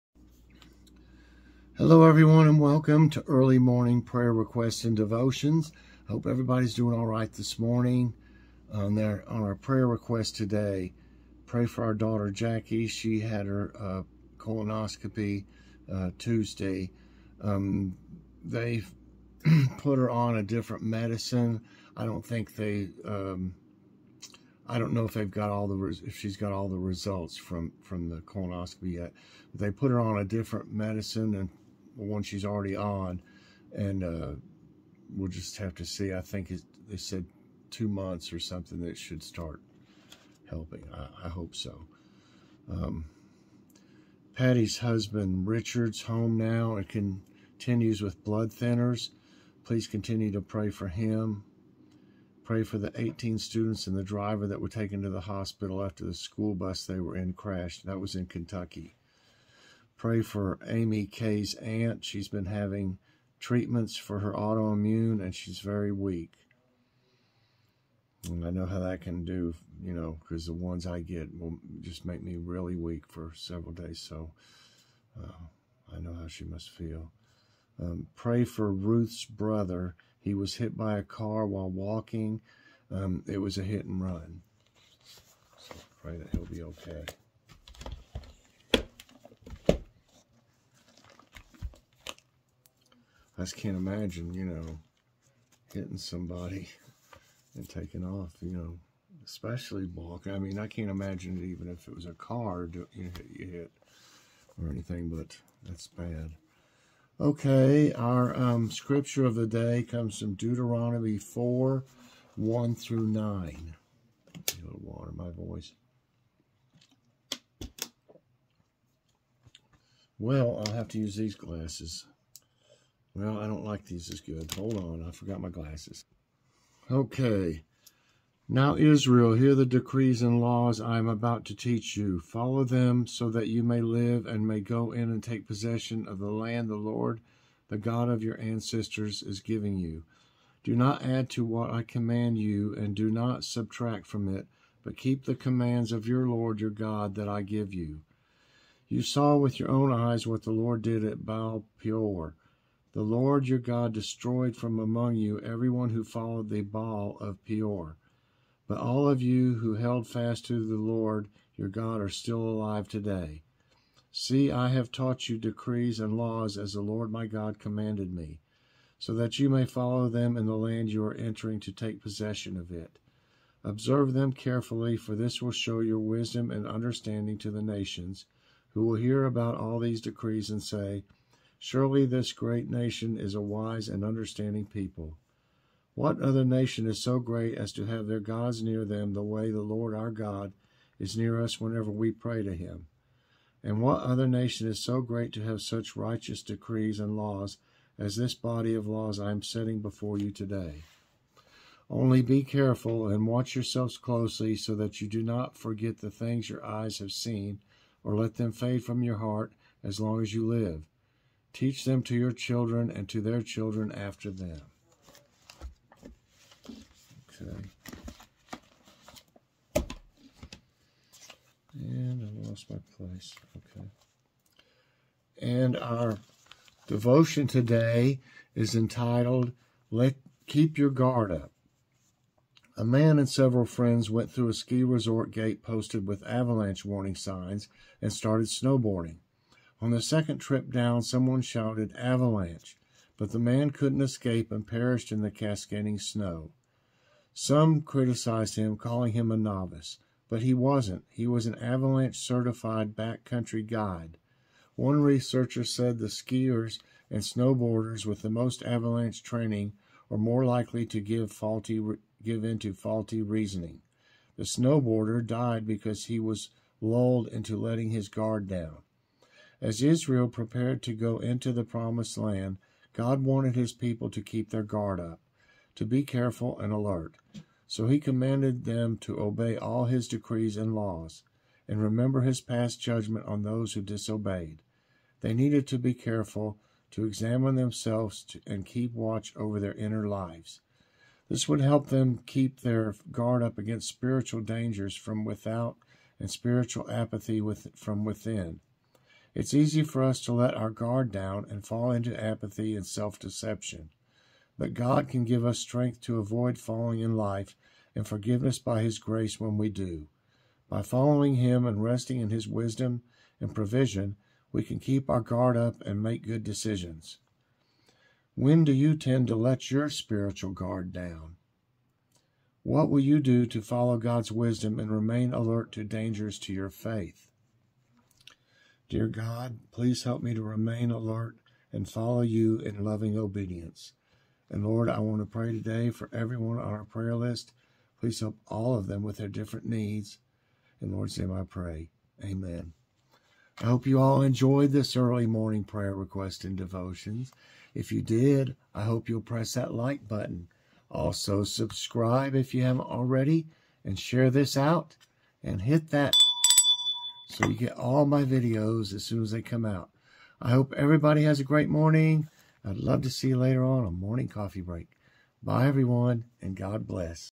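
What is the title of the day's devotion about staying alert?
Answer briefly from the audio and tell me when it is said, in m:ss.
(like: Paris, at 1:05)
Keep Your Guard Up, at 3:50.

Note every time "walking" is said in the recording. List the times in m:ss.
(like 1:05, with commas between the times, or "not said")
1:21, 1:39.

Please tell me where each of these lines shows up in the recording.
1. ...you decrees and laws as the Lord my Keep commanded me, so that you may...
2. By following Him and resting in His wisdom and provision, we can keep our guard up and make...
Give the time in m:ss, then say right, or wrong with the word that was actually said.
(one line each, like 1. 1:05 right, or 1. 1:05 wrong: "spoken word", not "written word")
1. 2:45 wrong: "God", not "Keep"
2. 5:10 right.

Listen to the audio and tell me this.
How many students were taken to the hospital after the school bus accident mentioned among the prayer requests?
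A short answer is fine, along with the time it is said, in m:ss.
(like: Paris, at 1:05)
18, at 0:52.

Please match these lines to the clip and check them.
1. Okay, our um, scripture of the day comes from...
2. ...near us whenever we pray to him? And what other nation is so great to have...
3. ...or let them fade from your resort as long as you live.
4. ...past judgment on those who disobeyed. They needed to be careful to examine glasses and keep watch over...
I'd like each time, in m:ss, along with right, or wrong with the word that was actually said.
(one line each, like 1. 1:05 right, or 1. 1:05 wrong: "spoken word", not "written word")
1. 1:47 right
2. 3:11 right
3. 3:28 wrong: "heart", not "resort"
4. 4:42 wrong: "themselves", not "glasses".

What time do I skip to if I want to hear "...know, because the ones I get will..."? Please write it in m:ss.
1:09.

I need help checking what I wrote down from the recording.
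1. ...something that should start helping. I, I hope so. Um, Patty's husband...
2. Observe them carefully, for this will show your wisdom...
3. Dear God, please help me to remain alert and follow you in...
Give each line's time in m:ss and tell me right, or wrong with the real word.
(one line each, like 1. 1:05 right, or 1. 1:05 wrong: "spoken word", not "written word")
1. 0:38 right
2. 2:53 right
3. 5:28 right.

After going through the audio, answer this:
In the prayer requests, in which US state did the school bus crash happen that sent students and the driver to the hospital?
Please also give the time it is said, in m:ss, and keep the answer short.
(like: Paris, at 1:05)
Kentucky, at 0:58.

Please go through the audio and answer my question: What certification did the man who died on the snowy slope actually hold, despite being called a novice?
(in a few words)
backcountry guide.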